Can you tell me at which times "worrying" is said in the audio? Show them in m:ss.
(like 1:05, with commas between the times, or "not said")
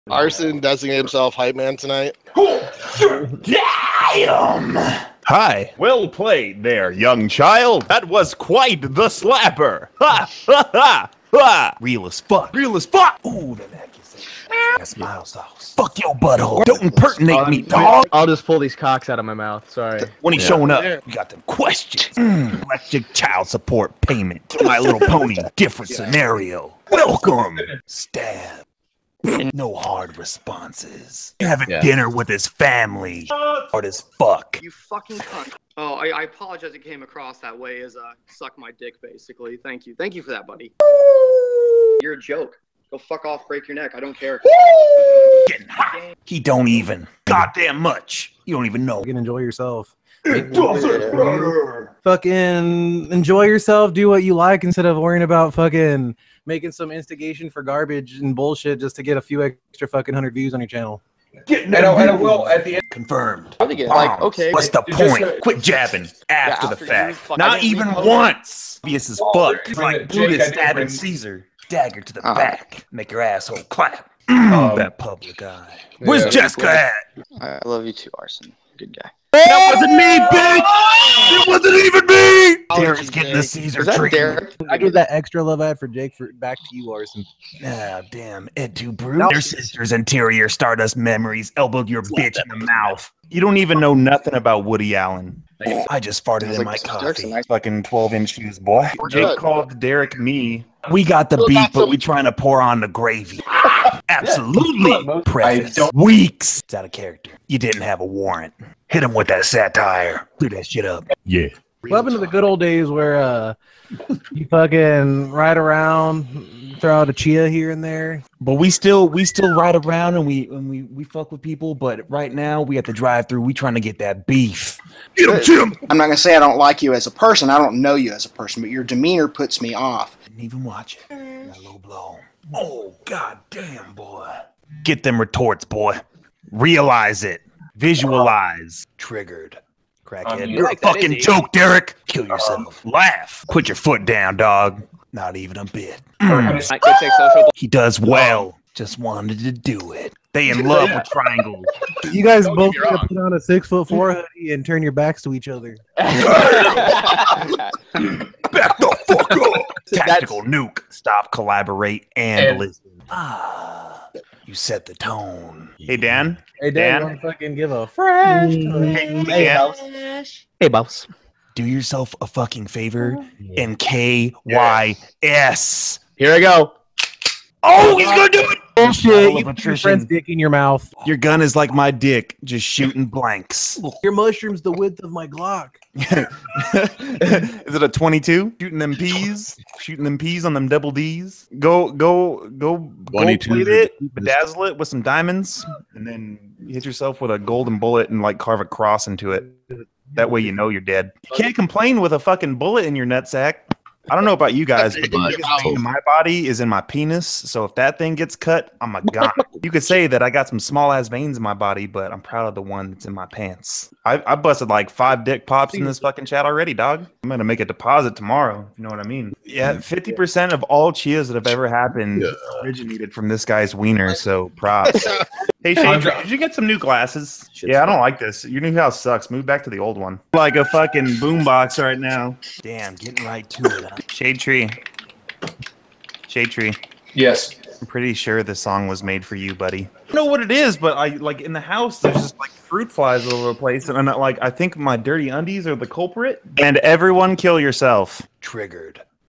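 0:54.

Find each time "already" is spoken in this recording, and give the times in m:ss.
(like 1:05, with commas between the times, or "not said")
3:36.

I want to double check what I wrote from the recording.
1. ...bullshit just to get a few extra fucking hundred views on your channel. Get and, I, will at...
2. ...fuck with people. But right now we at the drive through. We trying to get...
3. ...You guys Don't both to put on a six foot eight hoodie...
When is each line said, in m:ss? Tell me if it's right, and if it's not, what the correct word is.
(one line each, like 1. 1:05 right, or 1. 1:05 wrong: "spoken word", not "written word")
1. 0:58 right
2. 2:01 right
3. 2:32 wrong: "four", not "eight".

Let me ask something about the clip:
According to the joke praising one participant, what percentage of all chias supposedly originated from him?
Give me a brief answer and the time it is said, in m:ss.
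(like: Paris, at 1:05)
50%, at 3:39.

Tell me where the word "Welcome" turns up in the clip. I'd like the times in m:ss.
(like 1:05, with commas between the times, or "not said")
0:26, 1:51.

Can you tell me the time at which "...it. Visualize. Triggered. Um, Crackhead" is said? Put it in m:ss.
2:17.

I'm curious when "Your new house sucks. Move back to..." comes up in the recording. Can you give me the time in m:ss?
3:48.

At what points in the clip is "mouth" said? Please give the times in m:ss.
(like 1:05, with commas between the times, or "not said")
0:19, 1:32, 3:00.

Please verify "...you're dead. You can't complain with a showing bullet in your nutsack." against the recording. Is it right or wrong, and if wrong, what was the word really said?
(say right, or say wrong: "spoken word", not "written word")
wrong: "fucking", not "showing".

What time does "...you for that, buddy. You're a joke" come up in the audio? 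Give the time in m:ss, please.
0:40.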